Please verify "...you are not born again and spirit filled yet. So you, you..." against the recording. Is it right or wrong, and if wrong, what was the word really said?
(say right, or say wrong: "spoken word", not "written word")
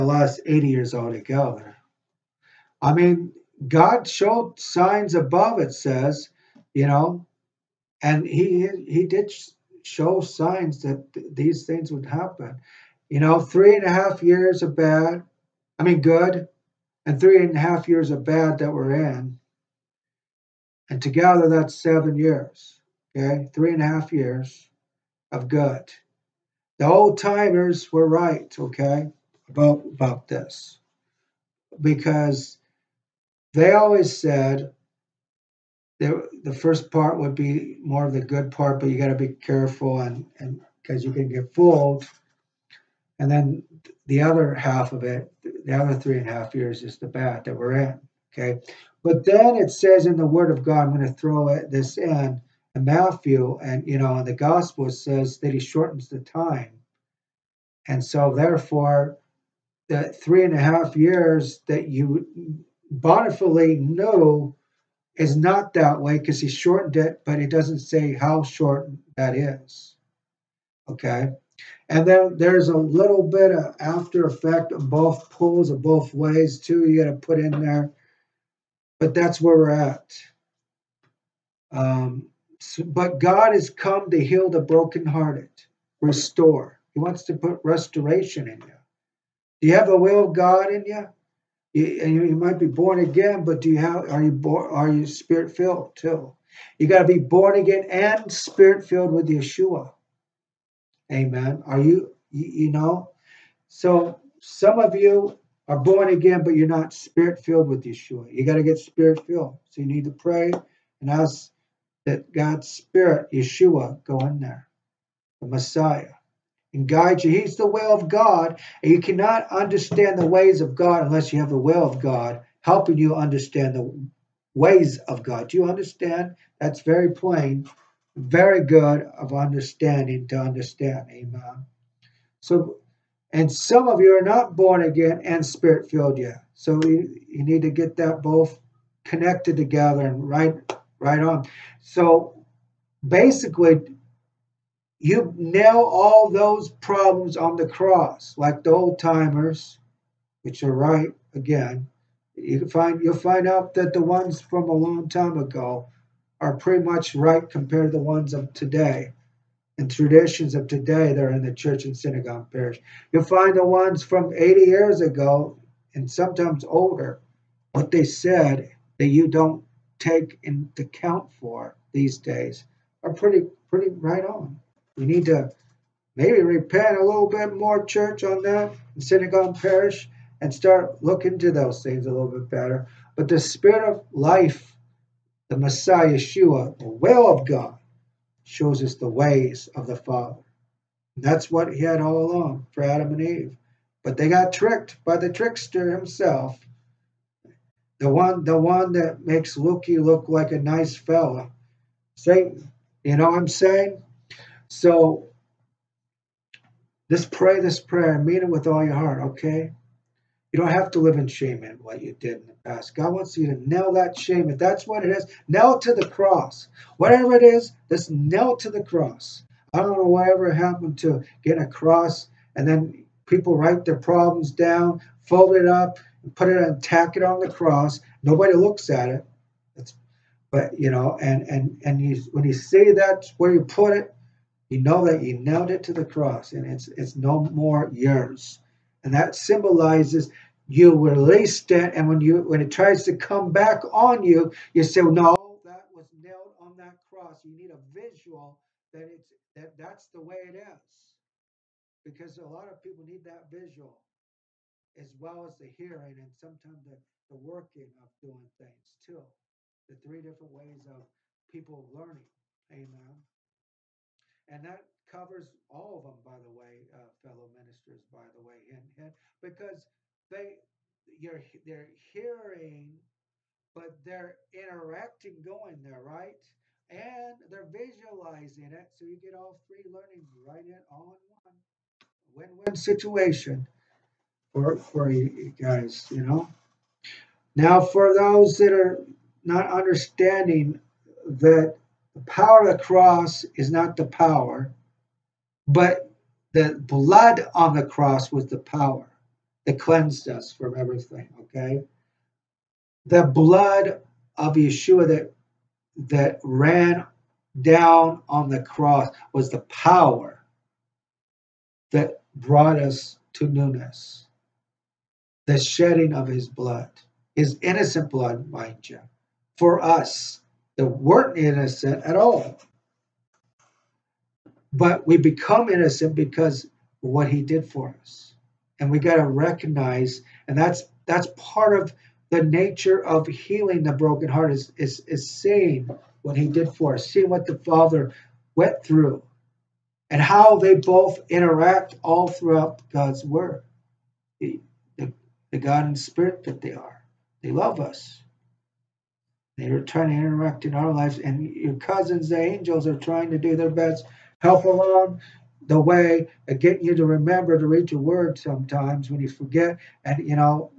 right.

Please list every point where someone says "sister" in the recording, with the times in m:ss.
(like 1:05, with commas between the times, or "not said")
not said.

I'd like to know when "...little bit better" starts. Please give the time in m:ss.
3:02.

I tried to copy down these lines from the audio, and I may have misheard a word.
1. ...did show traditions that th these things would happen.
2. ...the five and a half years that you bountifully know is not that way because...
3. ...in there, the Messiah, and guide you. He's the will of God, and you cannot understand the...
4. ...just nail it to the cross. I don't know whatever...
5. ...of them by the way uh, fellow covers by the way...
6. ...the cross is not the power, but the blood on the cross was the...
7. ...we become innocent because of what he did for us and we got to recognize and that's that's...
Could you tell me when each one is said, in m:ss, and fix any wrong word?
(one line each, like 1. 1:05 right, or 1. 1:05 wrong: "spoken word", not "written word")
1. 0:09 wrong: "signs", not "traditions"
2. 0:59 wrong: "three", not "five"
3. 1:54 right
4. 3:37 right
5. 4:25 wrong: "ministers", not "covers"
6. 4:52 right
7. 5:25 right.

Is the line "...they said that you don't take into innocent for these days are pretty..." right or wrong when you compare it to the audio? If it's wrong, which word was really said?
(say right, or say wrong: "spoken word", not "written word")
wrong: "account", not "innocent".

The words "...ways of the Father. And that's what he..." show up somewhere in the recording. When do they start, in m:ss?
3:09.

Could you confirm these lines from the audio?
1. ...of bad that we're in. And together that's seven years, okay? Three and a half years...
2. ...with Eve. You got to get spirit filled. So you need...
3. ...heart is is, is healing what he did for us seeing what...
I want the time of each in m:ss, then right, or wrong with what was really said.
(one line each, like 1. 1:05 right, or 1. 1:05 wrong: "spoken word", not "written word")
1. 0:18 right
2. 1:47 wrong: "Yeshua", not "Eve"
3. 5:34 wrong: "seeing", not "healing".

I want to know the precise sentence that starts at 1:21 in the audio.
Um, so, but God has come to heal the brokenhearted, restore.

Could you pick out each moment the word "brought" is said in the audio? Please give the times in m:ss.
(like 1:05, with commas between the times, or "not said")
5:12.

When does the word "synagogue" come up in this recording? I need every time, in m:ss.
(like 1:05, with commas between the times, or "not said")
2:41, 2:59.